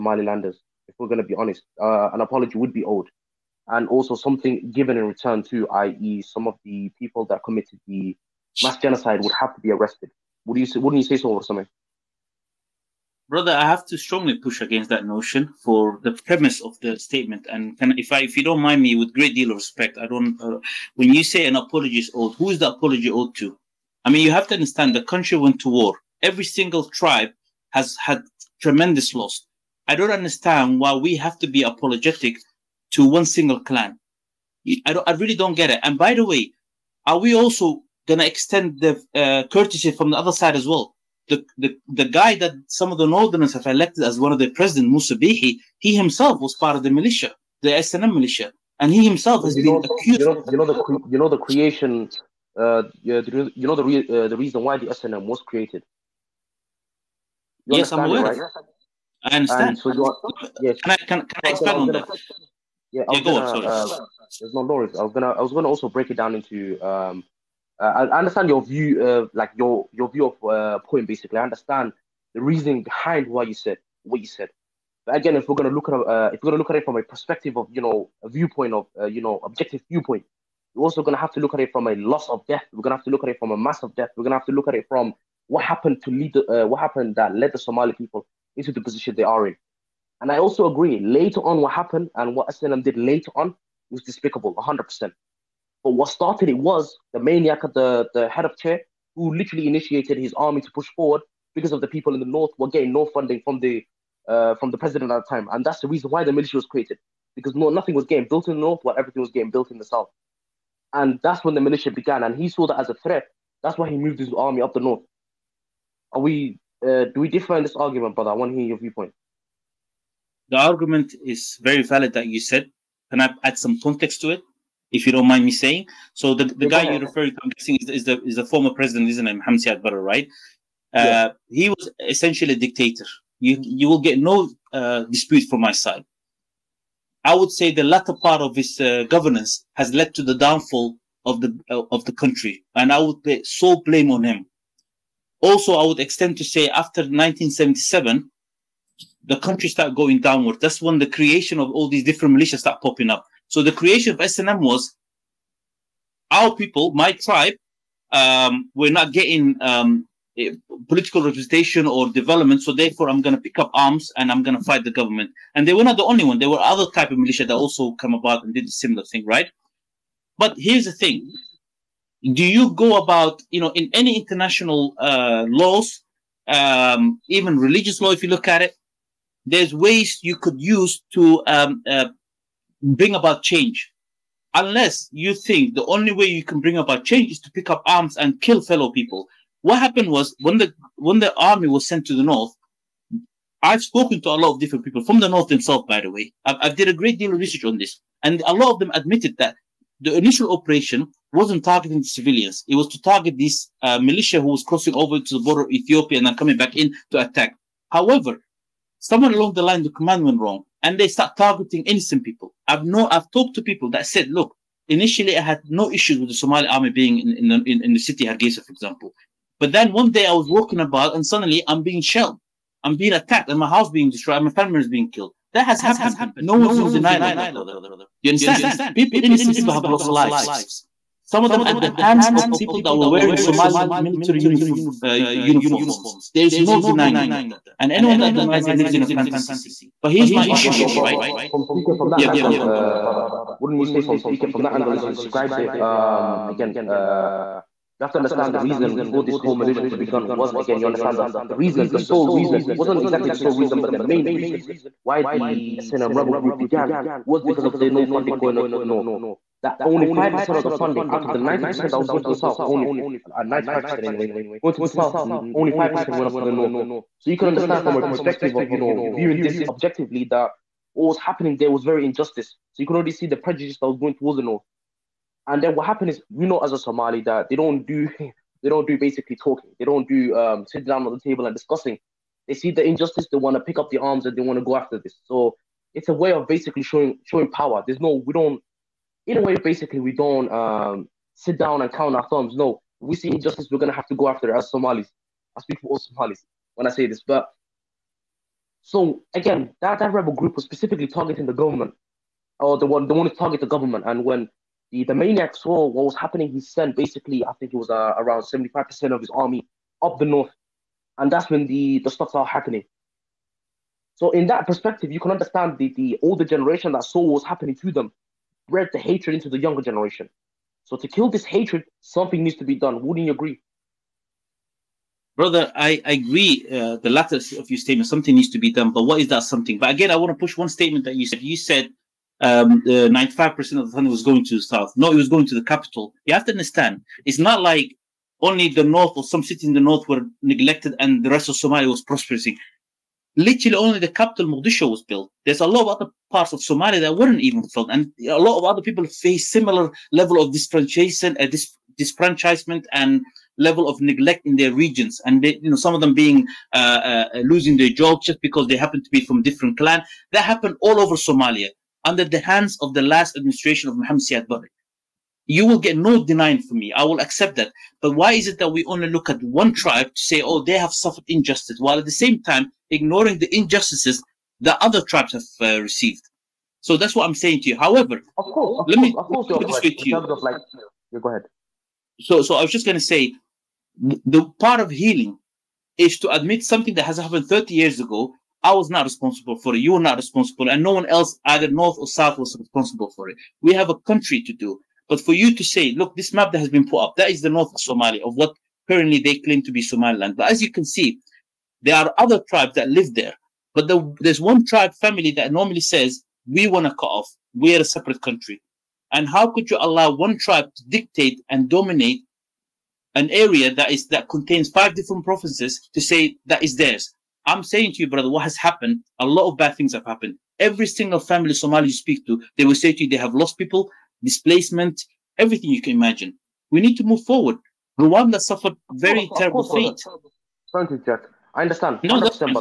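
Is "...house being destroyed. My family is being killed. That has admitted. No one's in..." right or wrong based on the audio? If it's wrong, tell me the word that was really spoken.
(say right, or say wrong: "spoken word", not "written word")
wrong: "happened", not "admitted".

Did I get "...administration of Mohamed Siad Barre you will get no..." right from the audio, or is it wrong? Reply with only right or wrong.
right.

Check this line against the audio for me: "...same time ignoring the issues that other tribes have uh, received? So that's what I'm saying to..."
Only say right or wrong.
wrong.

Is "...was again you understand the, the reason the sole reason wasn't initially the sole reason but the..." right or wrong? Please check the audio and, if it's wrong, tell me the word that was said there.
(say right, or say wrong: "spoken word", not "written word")
wrong: "exactly", not "initially".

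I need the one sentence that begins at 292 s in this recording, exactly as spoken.
No, we see injustice, we're gonna have to go after it as Somalis.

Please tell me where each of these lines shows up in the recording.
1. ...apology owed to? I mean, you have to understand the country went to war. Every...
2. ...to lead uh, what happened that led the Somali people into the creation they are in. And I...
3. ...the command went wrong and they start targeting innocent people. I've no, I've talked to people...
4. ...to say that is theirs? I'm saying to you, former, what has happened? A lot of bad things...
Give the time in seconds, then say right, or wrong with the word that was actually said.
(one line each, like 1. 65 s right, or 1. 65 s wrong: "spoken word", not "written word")
1. 22 s right
2. 86 s wrong: "position", not "creation"
3. 209 s right
4. 415 s wrong: "brother", not "former".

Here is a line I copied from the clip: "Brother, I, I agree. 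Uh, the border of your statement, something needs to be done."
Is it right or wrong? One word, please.
wrong.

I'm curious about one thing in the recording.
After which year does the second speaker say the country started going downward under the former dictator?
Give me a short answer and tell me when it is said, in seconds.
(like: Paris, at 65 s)
1977, at 147 s.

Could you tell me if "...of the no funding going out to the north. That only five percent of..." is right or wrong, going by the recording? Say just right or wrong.
right.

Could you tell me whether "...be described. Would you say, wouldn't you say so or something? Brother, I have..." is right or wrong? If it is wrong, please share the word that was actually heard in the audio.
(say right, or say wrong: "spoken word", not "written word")
wrong: "arrested", not "described".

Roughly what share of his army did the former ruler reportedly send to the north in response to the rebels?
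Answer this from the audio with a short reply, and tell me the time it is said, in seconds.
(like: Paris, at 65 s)
75%, at 308 s.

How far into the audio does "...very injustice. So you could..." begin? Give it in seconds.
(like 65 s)
271 s.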